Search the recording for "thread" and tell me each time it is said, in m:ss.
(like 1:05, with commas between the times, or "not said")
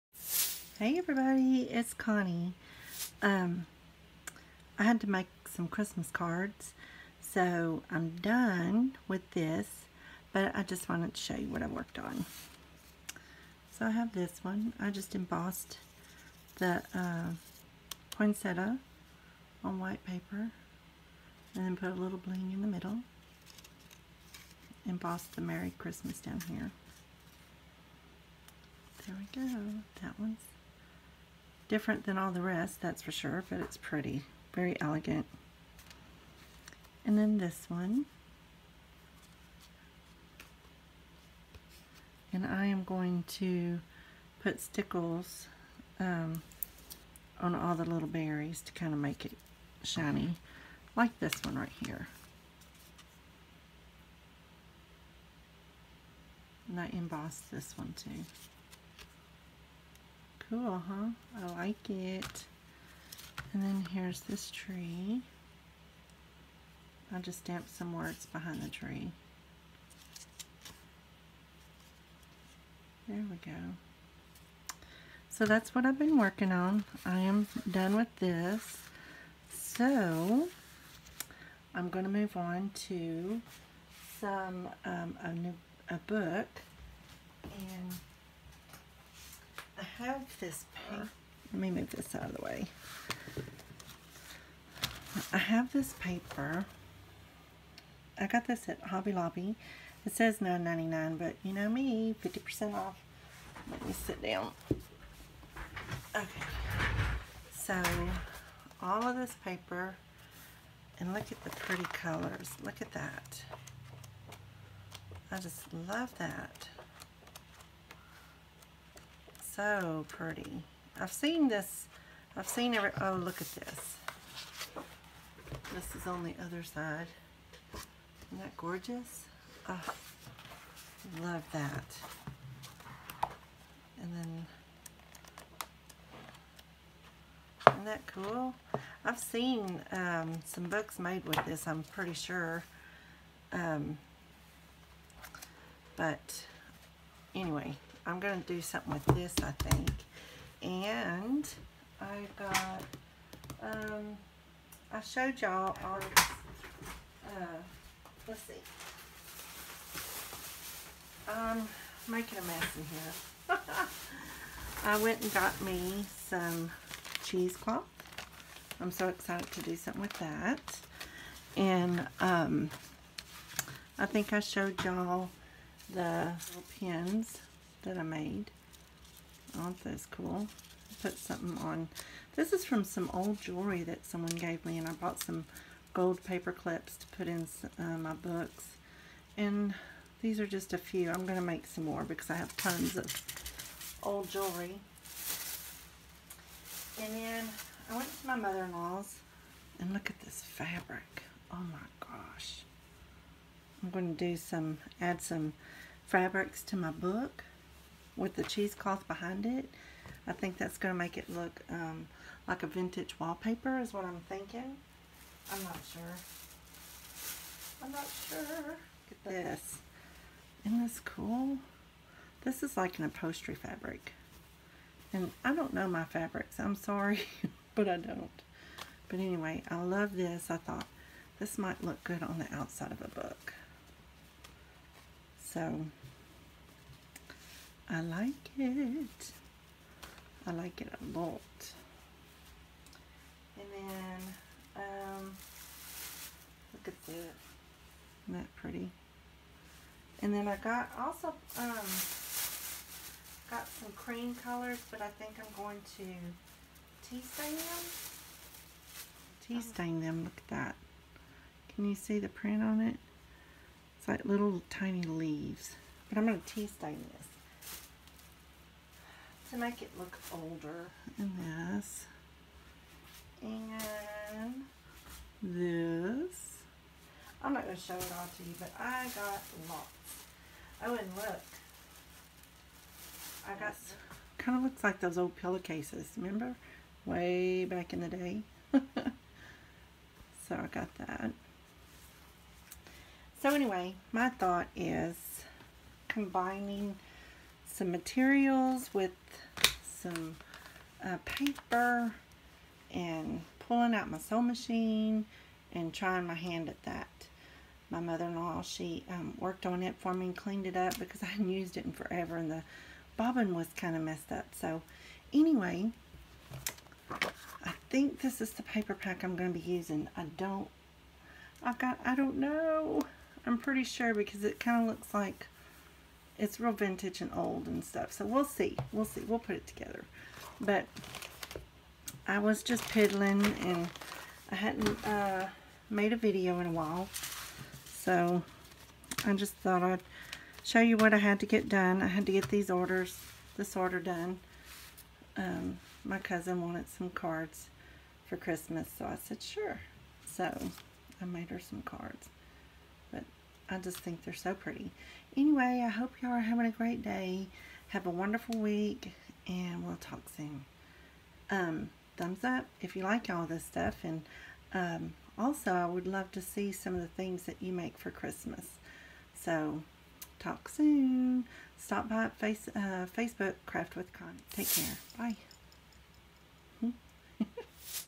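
not said.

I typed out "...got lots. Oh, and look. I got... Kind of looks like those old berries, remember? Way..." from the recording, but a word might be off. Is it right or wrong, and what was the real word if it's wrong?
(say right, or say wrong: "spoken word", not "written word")
wrong: "pillowcases", not "berries".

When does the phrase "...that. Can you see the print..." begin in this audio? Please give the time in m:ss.
4:20.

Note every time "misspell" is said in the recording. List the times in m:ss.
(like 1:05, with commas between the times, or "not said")
not said.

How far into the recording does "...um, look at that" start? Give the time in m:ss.
4:04.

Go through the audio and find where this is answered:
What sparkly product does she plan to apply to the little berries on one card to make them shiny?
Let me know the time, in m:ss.
0:44.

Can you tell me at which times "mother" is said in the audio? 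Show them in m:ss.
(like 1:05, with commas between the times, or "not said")
3:18, 5:07.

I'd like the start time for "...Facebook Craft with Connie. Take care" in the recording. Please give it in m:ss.
6:13.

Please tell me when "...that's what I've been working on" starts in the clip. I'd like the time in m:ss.
1:15.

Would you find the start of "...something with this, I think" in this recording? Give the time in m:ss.
2:28.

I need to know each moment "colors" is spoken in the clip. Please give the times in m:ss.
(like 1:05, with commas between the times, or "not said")
1:51, 4:14.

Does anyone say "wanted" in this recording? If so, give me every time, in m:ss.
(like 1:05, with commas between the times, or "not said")
0:10, 5:46.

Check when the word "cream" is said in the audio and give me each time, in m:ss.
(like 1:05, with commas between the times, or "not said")
4:13.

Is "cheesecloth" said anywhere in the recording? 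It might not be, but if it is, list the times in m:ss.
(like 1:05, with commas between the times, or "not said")
2:47, 3:28.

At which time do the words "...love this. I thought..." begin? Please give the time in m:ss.
3:49.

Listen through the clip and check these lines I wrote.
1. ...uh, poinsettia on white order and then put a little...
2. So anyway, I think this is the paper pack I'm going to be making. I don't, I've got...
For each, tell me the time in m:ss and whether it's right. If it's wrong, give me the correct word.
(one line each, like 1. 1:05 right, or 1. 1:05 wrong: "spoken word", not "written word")
1. 0:16 wrong: "paper", not "order"
2. 5:14 wrong: "using", not "making".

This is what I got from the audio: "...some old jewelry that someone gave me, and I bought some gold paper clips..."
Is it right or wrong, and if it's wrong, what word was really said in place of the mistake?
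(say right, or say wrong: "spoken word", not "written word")
right.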